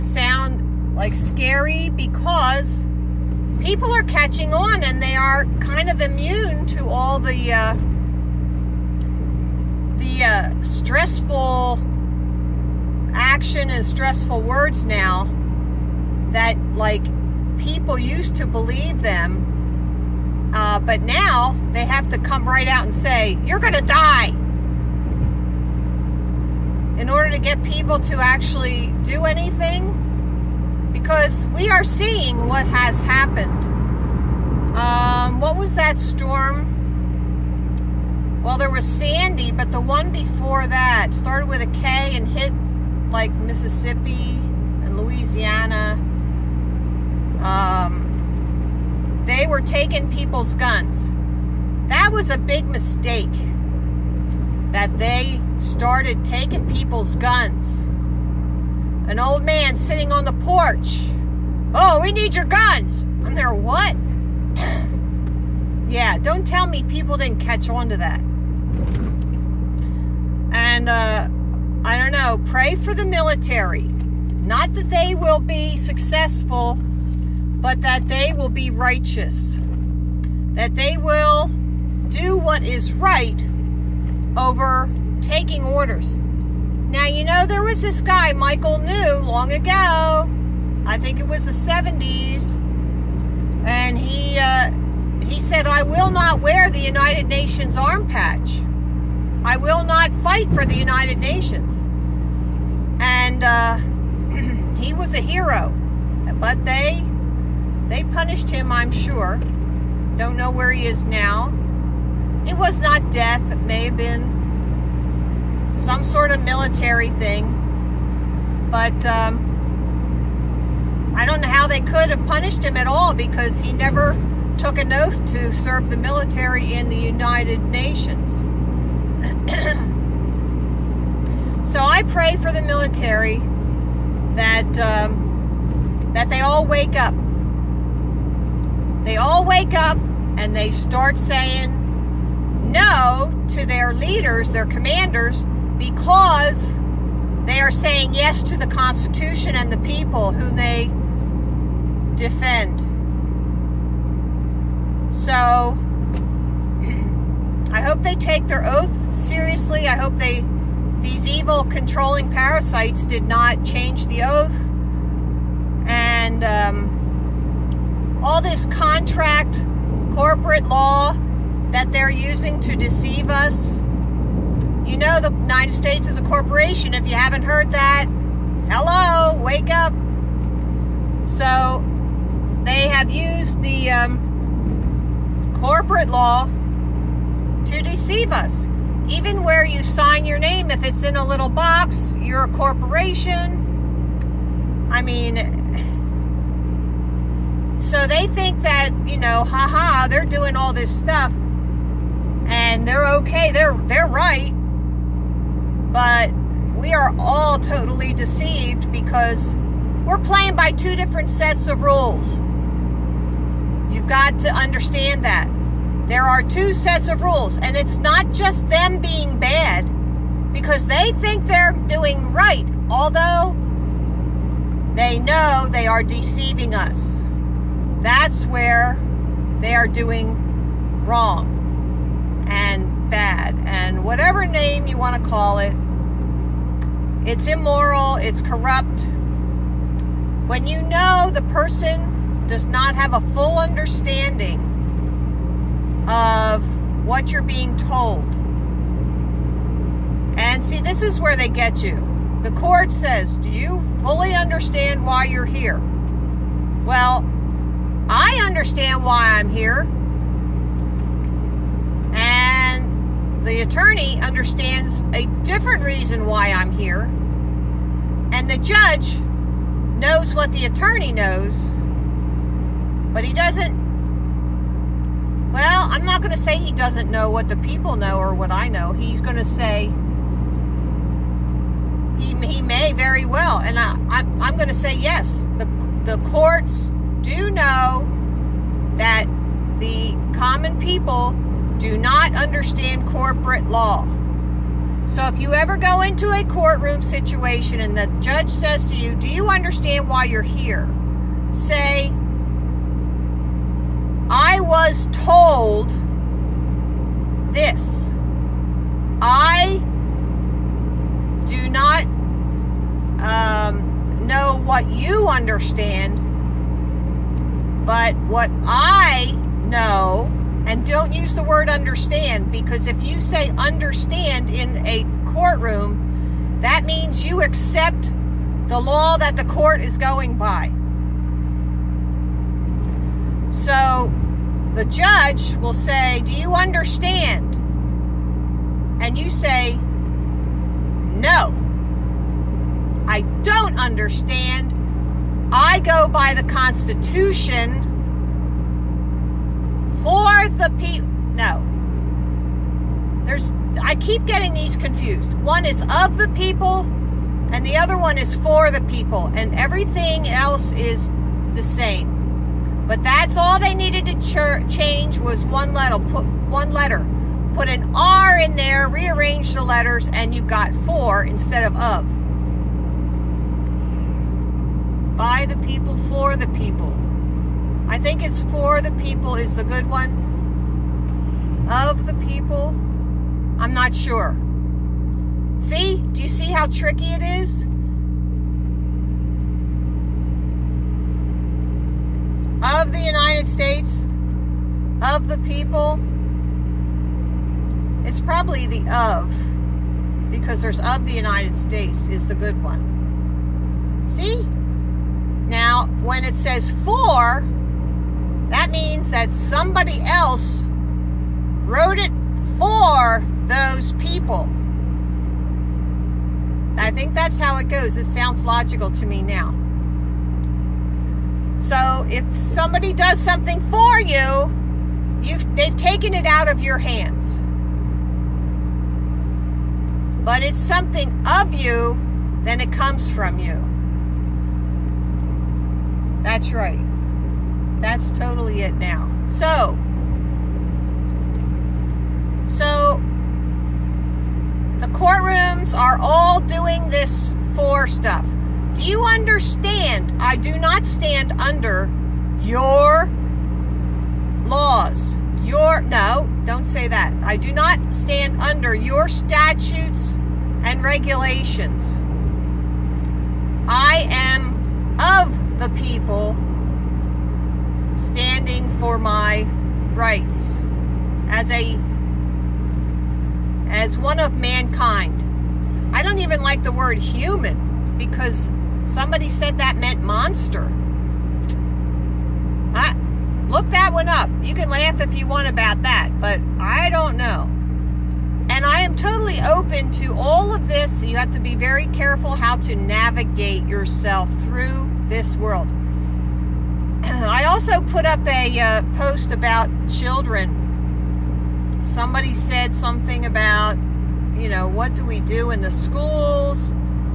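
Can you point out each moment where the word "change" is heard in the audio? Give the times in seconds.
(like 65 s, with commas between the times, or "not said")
163 s, 364 s.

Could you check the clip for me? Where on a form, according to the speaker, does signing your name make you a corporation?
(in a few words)
In a little box.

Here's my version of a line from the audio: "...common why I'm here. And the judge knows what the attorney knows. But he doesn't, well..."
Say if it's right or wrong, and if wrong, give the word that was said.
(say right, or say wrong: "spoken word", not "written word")
wrong: "reason", not "common".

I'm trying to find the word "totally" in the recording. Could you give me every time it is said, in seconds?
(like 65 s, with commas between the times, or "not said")
207 s, 438 s, 488 s.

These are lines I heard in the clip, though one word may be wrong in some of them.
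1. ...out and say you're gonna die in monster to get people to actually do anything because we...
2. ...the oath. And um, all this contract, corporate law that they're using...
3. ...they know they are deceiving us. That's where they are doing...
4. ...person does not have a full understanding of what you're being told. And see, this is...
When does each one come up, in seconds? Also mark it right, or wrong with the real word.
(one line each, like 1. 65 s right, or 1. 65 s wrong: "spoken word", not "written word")
1. 22 s wrong: "order", not "monster"
2. 164 s right
3. 224 s right
4. 241 s right.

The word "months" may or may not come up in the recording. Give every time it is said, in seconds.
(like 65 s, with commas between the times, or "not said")
not said.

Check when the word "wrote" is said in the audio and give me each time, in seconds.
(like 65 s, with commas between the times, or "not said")
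411 s.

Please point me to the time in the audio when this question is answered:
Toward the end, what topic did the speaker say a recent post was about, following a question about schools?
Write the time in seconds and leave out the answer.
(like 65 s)
499 s.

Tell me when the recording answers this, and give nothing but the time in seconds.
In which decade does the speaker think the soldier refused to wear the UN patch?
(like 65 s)
91 s.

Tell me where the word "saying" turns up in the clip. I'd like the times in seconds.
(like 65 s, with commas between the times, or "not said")
141 s, 147 s.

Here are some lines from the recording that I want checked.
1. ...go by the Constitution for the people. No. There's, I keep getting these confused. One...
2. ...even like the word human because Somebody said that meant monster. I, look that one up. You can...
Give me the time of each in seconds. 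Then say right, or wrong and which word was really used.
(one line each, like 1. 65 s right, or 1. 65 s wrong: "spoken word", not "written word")
1. 345 s right
2. 476 s right.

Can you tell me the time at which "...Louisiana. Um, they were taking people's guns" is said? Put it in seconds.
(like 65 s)
44 s.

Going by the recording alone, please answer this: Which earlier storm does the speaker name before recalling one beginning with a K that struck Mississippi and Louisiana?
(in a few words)
Sandy.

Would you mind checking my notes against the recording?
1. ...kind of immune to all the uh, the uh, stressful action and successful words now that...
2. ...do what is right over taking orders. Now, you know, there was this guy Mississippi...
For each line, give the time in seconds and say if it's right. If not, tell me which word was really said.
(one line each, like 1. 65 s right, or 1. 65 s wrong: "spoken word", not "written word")
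1. 5 s wrong: "stressful", not "successful"
2. 82 s wrong: "Michael", not "Mississippi".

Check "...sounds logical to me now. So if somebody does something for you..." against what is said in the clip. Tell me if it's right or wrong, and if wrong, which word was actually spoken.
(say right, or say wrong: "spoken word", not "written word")
right.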